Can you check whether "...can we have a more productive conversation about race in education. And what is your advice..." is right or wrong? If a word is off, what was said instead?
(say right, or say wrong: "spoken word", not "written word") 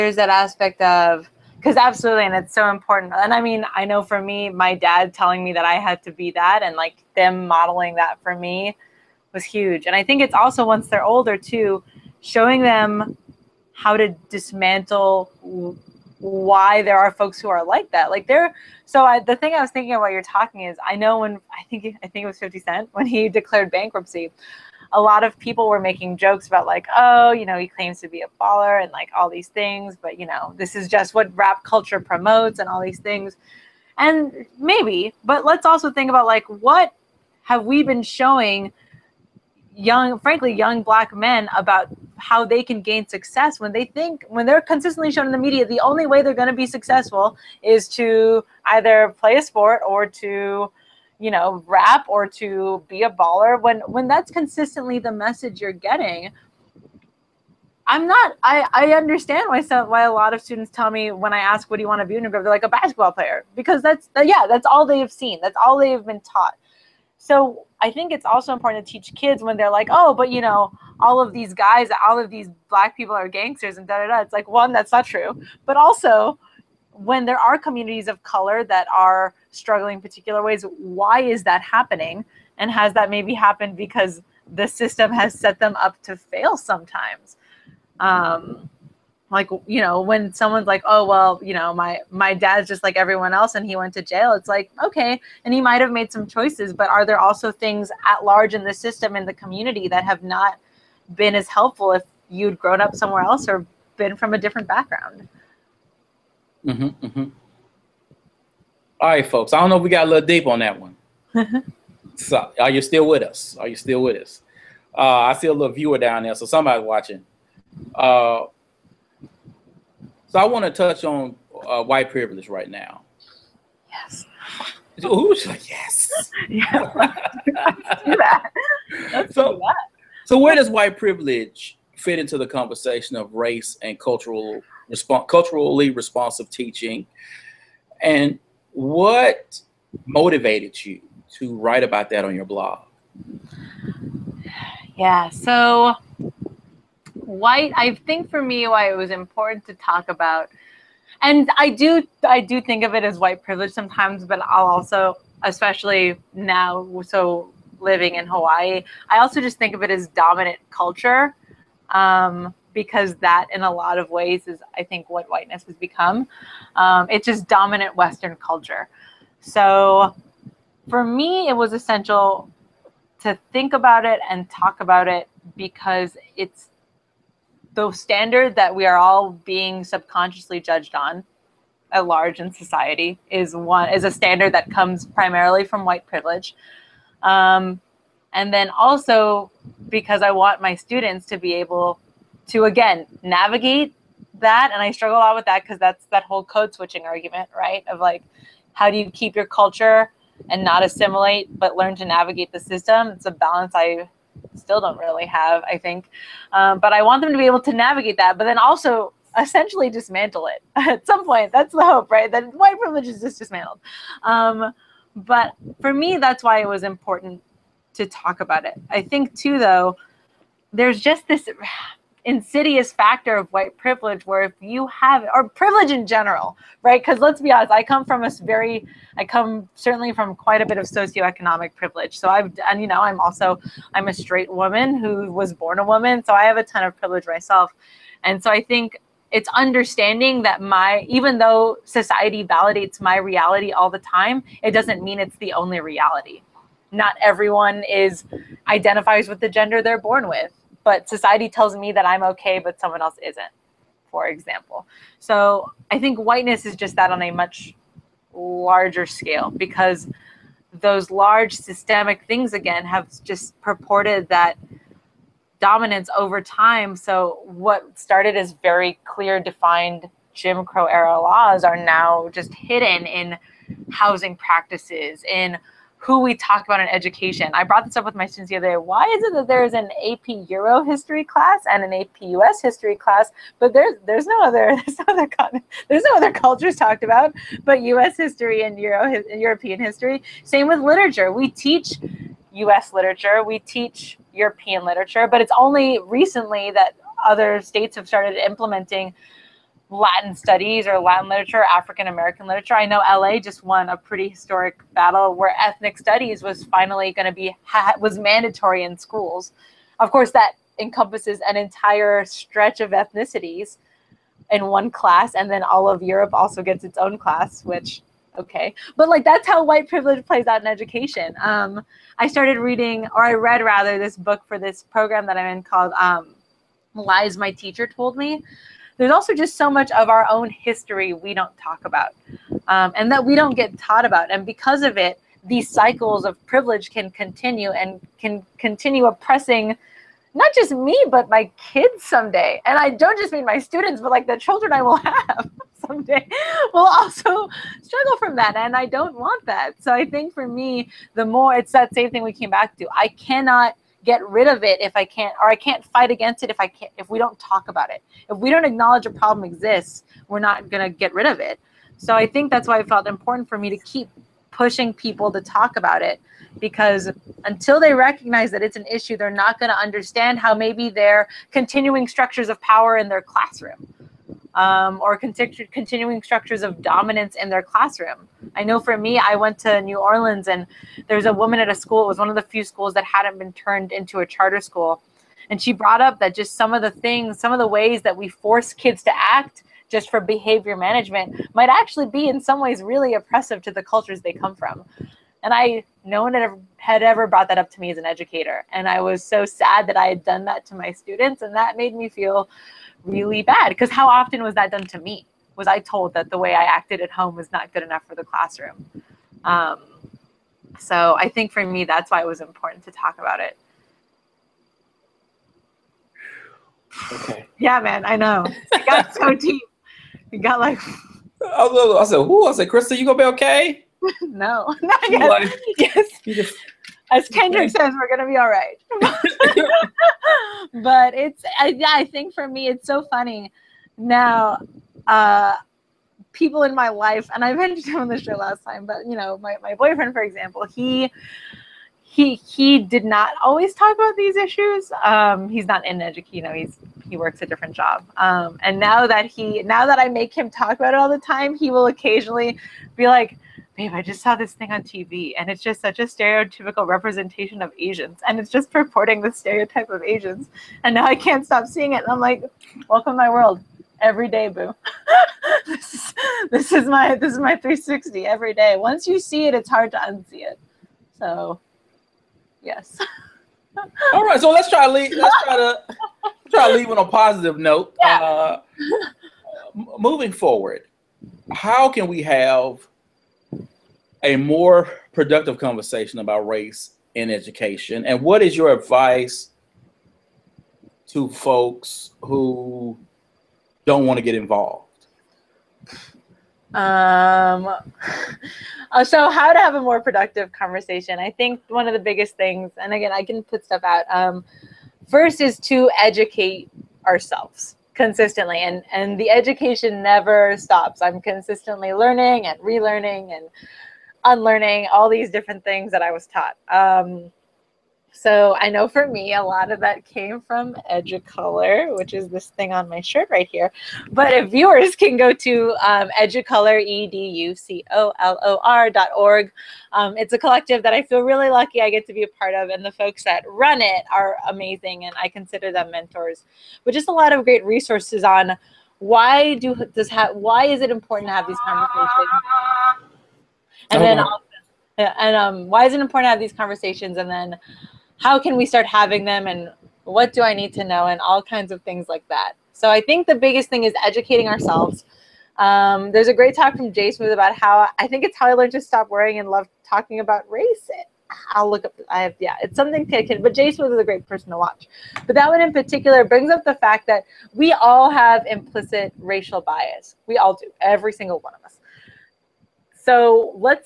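right.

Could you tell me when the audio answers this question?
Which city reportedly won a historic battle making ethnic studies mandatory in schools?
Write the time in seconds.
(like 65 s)
302 s.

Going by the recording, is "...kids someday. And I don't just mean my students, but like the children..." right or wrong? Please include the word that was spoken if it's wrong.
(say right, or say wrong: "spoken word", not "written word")
right.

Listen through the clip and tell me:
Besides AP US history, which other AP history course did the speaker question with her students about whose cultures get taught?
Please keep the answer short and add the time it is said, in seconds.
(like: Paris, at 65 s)
AP Euro history, at 280 s.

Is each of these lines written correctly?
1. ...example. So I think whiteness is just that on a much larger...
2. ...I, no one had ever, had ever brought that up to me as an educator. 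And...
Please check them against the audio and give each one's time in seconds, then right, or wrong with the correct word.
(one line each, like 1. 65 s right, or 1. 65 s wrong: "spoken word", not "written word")
1. 254 s right
2. 395 s right.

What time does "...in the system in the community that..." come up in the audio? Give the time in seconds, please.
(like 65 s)
98 s.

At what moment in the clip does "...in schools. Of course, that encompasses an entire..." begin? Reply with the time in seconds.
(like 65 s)
308 s.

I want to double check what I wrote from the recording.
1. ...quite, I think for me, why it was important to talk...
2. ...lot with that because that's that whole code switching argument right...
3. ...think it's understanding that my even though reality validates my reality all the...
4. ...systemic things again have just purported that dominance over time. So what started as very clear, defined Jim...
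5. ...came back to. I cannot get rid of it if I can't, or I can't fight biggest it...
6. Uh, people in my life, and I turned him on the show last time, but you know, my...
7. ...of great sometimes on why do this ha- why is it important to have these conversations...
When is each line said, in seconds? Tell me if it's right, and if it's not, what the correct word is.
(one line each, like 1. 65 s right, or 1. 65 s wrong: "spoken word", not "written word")
1. 147 s wrong: "white", not "quite"
2. 195 s right
3. 238 s wrong: "society", not "reality"
4. 261 s right
5. 352 s wrong: "against", not "biggest"
6. 435 s wrong: "mentioned", not "turned"
7. 537 s wrong: "resources", not "sometimes".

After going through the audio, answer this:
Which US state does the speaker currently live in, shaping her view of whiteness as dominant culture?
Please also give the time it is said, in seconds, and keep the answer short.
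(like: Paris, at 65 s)
Hawaii, at 158 s.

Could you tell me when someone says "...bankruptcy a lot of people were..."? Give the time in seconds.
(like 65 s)
23 s.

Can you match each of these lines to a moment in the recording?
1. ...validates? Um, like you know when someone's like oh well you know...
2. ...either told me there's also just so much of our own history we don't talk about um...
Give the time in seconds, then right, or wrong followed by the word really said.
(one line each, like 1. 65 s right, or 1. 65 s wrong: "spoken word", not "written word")
1. 86 s wrong: "sometimes", not "validates"
2. 327 s wrong: "teacher", not "either".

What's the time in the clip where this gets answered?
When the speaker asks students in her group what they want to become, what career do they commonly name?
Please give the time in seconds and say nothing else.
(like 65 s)
62 s.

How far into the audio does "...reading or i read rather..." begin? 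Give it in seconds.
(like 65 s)
322 s.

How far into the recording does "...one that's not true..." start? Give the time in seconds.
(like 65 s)
74 s.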